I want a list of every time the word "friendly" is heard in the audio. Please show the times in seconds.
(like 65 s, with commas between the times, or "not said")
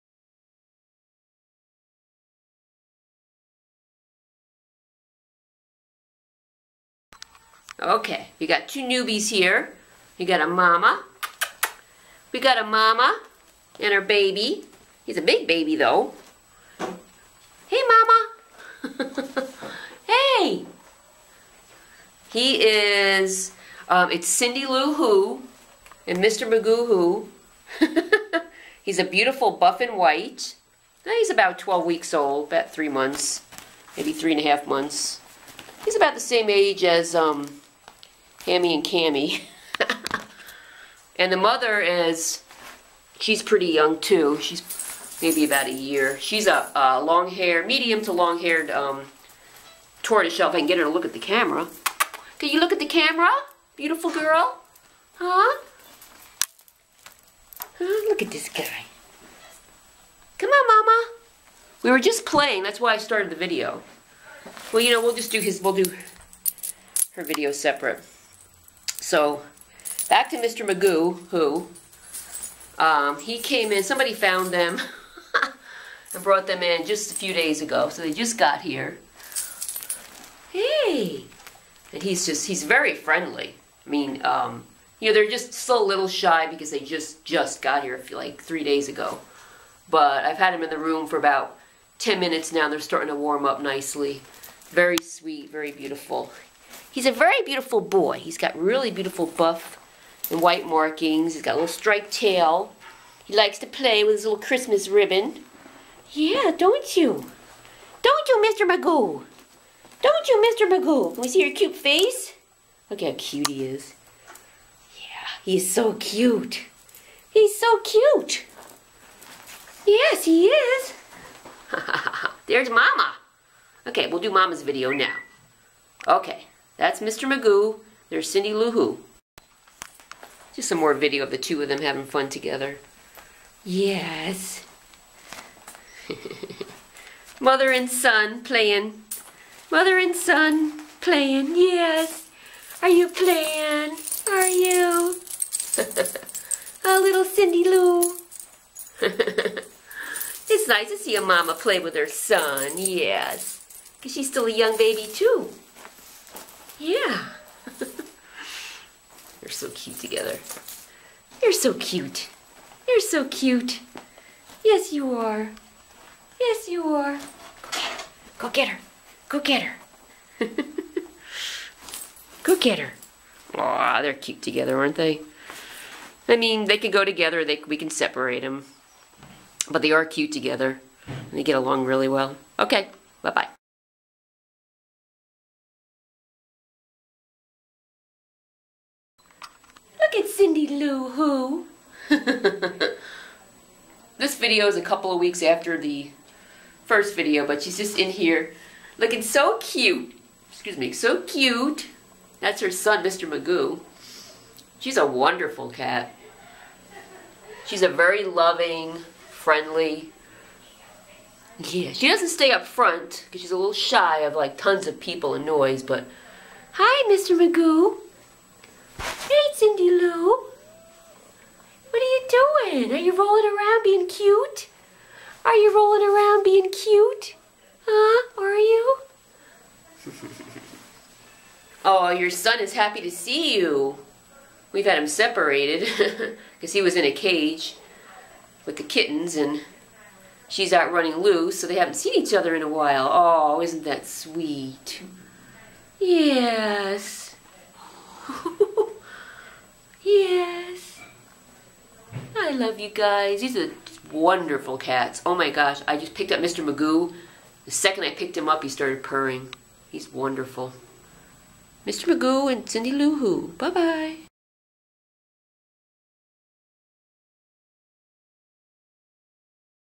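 82 s, 209 s.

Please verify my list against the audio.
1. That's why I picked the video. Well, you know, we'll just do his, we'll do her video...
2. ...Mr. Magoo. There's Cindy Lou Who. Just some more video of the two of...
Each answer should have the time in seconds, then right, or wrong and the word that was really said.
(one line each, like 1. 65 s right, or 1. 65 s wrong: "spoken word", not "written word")
1. 62 s wrong: "started", not "picked"
2. 126 s right.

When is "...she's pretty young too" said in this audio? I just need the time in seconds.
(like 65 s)
43 s.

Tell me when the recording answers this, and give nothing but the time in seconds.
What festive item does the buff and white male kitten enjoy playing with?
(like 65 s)
104 s.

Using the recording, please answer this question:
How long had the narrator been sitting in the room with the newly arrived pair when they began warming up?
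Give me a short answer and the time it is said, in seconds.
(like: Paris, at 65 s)
10 minutes, at 91 s.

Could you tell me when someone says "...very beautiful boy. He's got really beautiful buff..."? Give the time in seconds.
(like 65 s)
97 s.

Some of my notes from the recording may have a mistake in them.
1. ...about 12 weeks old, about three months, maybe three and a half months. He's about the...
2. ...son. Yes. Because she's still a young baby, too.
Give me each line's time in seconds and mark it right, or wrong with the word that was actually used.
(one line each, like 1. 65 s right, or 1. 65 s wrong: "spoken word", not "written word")
1. 31 s right
2. 152 s right.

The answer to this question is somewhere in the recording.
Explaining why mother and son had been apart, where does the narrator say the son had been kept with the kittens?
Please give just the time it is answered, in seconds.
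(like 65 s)
236 s.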